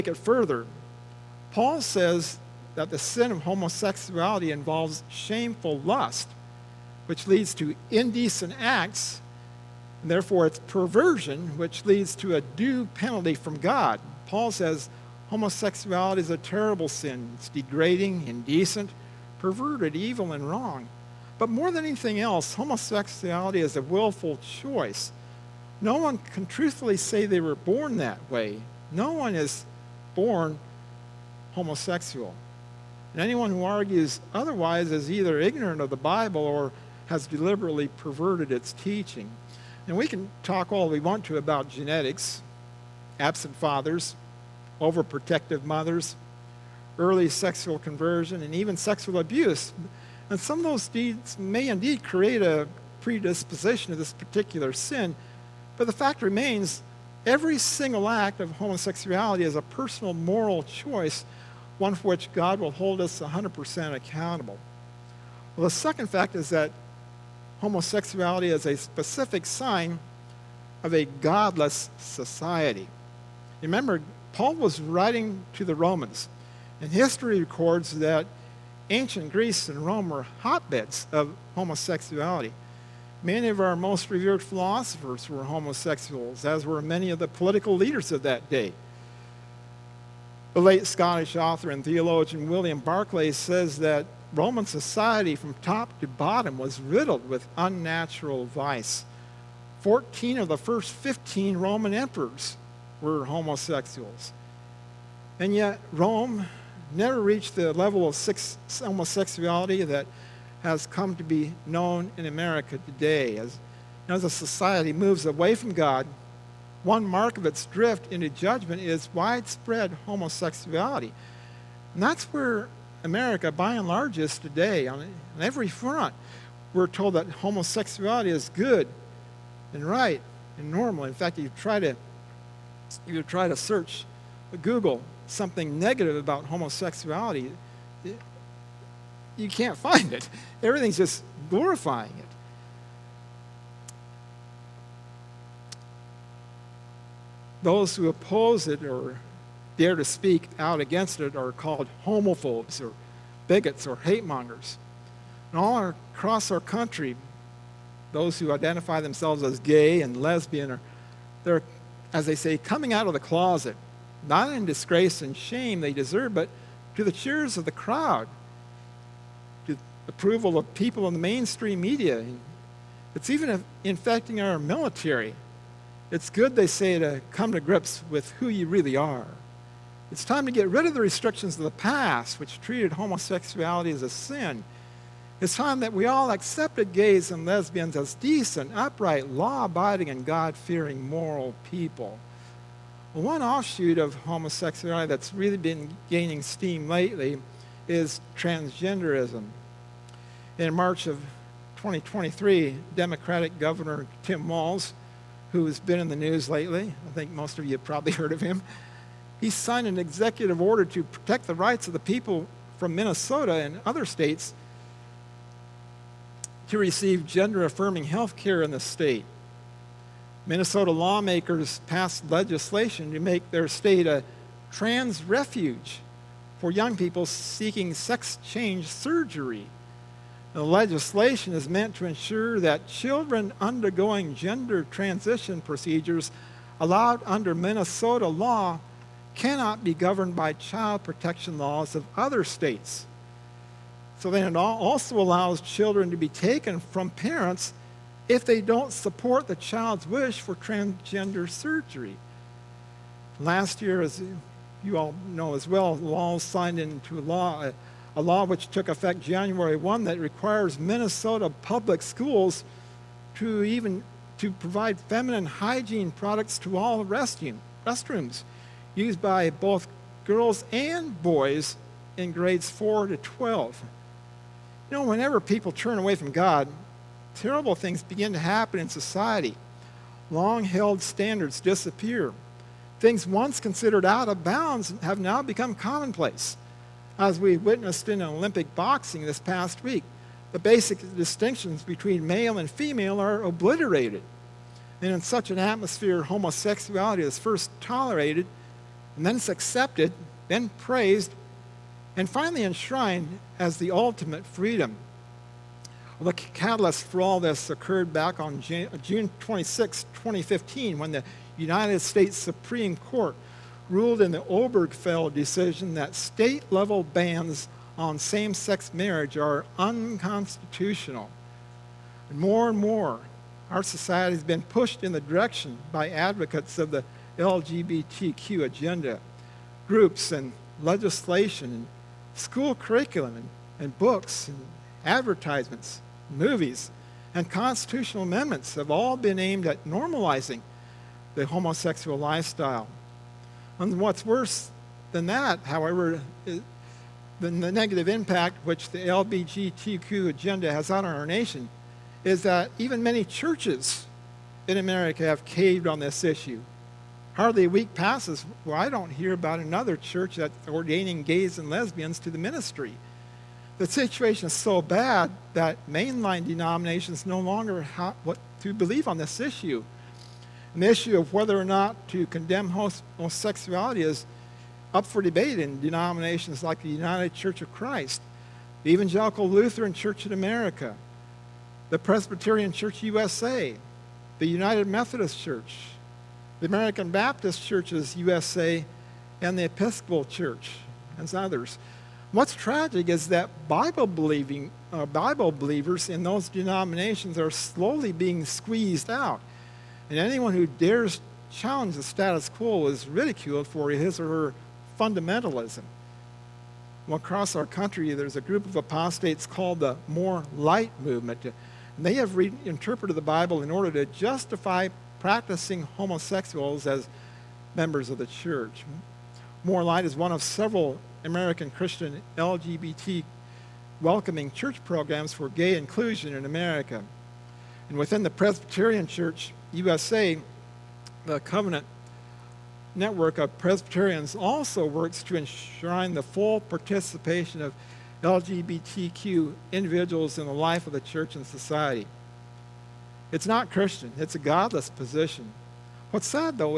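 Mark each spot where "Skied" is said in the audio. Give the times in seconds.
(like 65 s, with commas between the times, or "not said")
not said.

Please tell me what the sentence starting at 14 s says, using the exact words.
Paul says homosexuality is a terrible sin.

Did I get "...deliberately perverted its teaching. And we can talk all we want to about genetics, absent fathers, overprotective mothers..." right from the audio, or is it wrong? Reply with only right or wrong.
right.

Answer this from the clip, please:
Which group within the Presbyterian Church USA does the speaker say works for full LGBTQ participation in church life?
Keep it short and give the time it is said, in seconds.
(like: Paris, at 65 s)
Covenant Network of Presbyterians, at 431 s.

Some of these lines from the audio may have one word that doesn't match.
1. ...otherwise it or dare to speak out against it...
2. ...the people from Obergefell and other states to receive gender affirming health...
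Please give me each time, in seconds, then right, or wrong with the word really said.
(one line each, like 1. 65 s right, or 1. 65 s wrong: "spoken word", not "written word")
1. 148 s wrong: "oppose", not "otherwise"
2. 211 s wrong: "Minnesota", not "Obergefell".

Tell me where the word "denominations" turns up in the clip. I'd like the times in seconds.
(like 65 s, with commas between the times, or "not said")
366 s, 375 s, 396 s.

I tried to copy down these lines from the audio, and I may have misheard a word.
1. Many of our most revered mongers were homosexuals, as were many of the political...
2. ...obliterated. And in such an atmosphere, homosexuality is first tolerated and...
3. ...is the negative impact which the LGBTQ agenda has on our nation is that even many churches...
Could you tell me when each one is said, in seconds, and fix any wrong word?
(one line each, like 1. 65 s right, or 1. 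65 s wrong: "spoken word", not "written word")
1. 83 s wrong: "philosophers", not "mongers"
2. 293 s right
3. 346 s right.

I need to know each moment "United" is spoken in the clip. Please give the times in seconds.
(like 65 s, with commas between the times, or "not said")
311 s, 376 s, 384 s.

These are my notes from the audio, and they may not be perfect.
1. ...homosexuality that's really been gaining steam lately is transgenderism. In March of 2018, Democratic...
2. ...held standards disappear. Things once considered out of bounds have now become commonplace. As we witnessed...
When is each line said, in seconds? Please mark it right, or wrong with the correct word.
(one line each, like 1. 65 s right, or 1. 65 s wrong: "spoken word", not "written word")
1. 194 s wrong: "2023", not "2018"
2. 280 s right.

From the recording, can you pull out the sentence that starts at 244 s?
So then it also allows children to be taken from parents if they don't support the child's wish for transgender surgery.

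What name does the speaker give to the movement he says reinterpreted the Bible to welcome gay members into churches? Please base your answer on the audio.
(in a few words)
More Light Movement.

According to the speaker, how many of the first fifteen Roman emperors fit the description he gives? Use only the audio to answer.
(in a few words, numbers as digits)
14.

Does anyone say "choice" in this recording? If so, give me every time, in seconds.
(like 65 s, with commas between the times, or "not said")
24 s, 60 s.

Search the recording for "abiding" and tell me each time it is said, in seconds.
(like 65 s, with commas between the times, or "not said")
189 s.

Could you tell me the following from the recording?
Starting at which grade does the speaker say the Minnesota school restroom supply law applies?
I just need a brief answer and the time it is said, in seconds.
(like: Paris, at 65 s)
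4, at 272 s.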